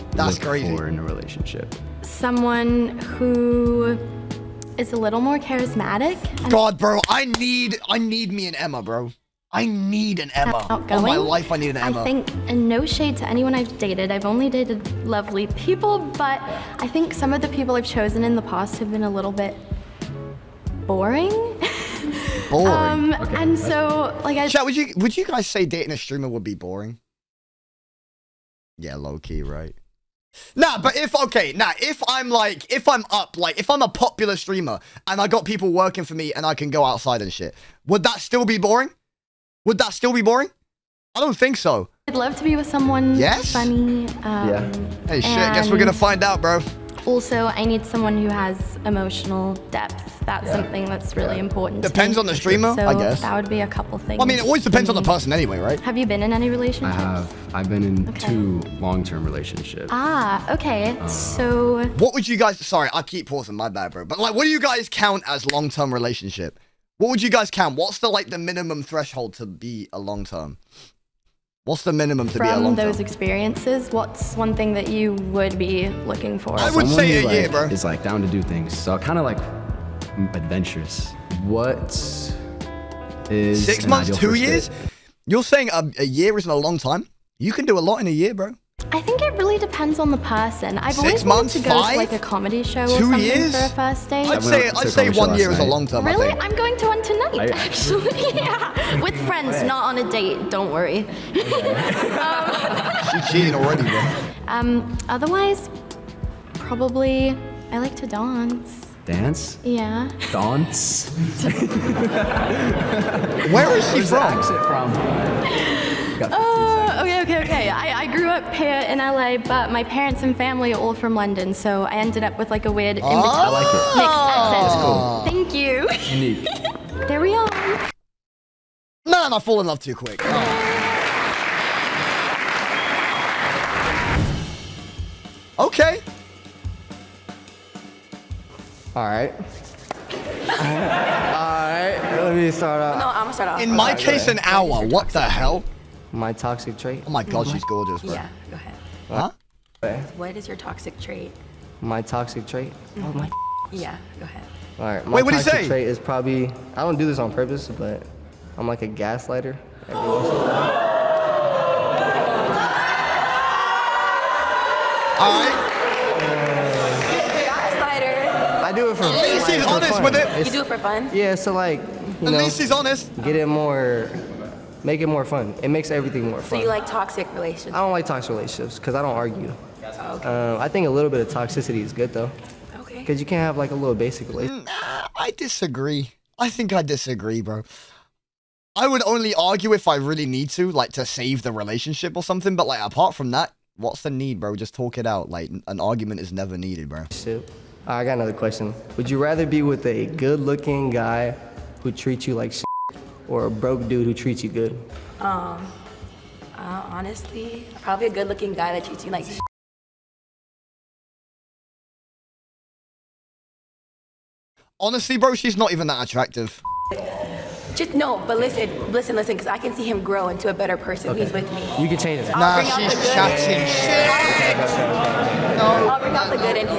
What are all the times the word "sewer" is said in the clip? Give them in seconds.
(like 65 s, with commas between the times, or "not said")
not said.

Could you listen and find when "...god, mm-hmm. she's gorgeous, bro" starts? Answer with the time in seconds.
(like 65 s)
147 s.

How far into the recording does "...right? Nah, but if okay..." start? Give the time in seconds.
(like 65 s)
29 s.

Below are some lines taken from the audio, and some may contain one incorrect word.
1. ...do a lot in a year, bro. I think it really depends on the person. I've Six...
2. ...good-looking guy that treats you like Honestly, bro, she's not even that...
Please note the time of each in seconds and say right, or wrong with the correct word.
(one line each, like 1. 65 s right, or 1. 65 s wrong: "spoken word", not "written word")
1. 87 s right
2. 208 s right.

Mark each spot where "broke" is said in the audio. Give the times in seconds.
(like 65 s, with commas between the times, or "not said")
203 s.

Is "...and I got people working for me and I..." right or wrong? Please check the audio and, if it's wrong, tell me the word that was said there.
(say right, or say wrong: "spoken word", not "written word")
right.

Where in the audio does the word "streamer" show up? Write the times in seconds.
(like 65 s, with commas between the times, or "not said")
25 s, 34 s, 52 s.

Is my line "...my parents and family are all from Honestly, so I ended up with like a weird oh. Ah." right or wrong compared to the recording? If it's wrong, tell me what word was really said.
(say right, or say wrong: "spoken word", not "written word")
wrong: "London", not "Honestly".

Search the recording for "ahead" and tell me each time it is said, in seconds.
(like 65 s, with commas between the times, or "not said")
148 s, 154 s.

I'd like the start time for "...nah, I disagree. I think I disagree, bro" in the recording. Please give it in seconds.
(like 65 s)
184 s.